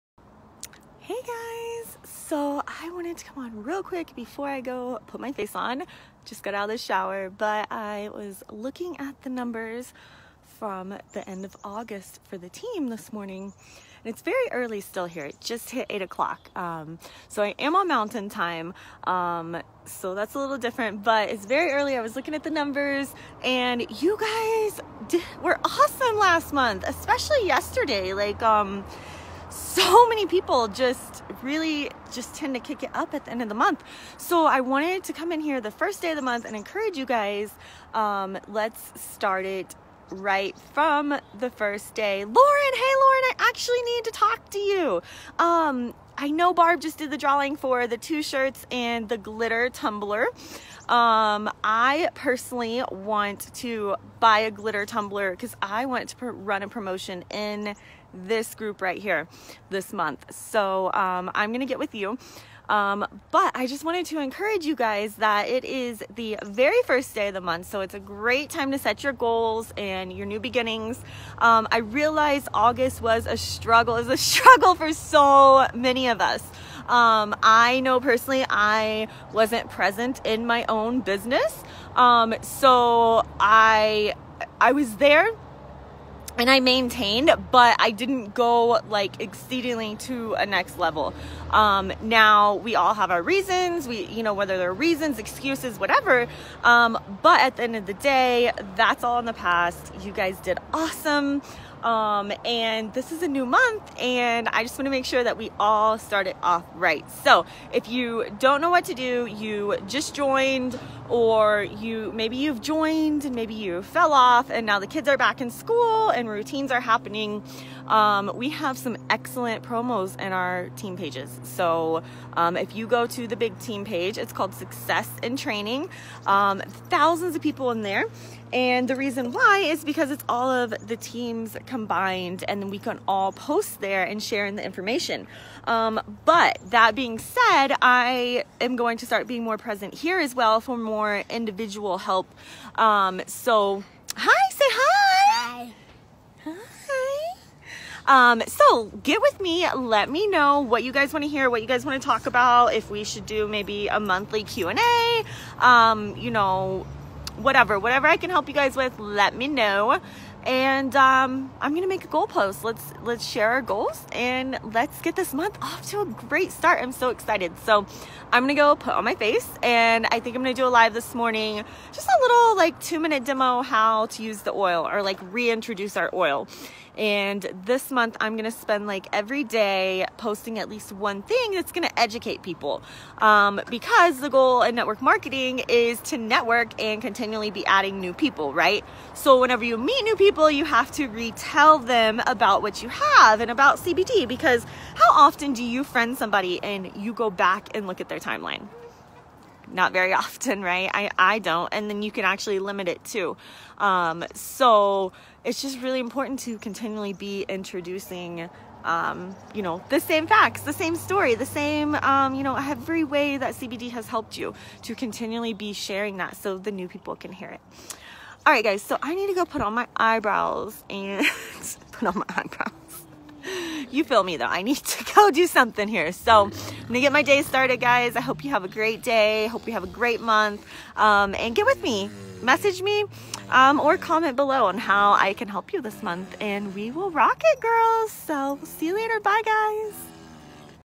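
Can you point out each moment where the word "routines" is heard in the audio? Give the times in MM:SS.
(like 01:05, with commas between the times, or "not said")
01:56.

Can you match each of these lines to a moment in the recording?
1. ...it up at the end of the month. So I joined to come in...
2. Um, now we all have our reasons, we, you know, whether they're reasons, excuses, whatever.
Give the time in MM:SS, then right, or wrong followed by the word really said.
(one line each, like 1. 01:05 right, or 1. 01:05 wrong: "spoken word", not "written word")
1. 00:32 wrong: "wanted", not "joined"
2. 01:31 right.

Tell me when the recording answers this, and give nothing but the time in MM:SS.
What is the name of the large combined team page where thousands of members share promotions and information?
02:04.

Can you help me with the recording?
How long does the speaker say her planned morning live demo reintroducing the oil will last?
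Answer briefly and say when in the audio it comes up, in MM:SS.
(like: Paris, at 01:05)
2 minutes, at 02:52.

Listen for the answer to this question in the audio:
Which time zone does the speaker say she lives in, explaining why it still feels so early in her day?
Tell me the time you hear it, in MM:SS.
00:17.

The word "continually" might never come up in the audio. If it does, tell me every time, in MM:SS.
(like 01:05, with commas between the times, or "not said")
03:07, 03:26, 03:34.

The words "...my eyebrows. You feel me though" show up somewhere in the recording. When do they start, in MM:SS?
03:42.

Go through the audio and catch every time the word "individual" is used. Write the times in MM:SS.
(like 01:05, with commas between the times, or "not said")
02:21.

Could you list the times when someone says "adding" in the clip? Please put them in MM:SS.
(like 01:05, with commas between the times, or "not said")
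03:07.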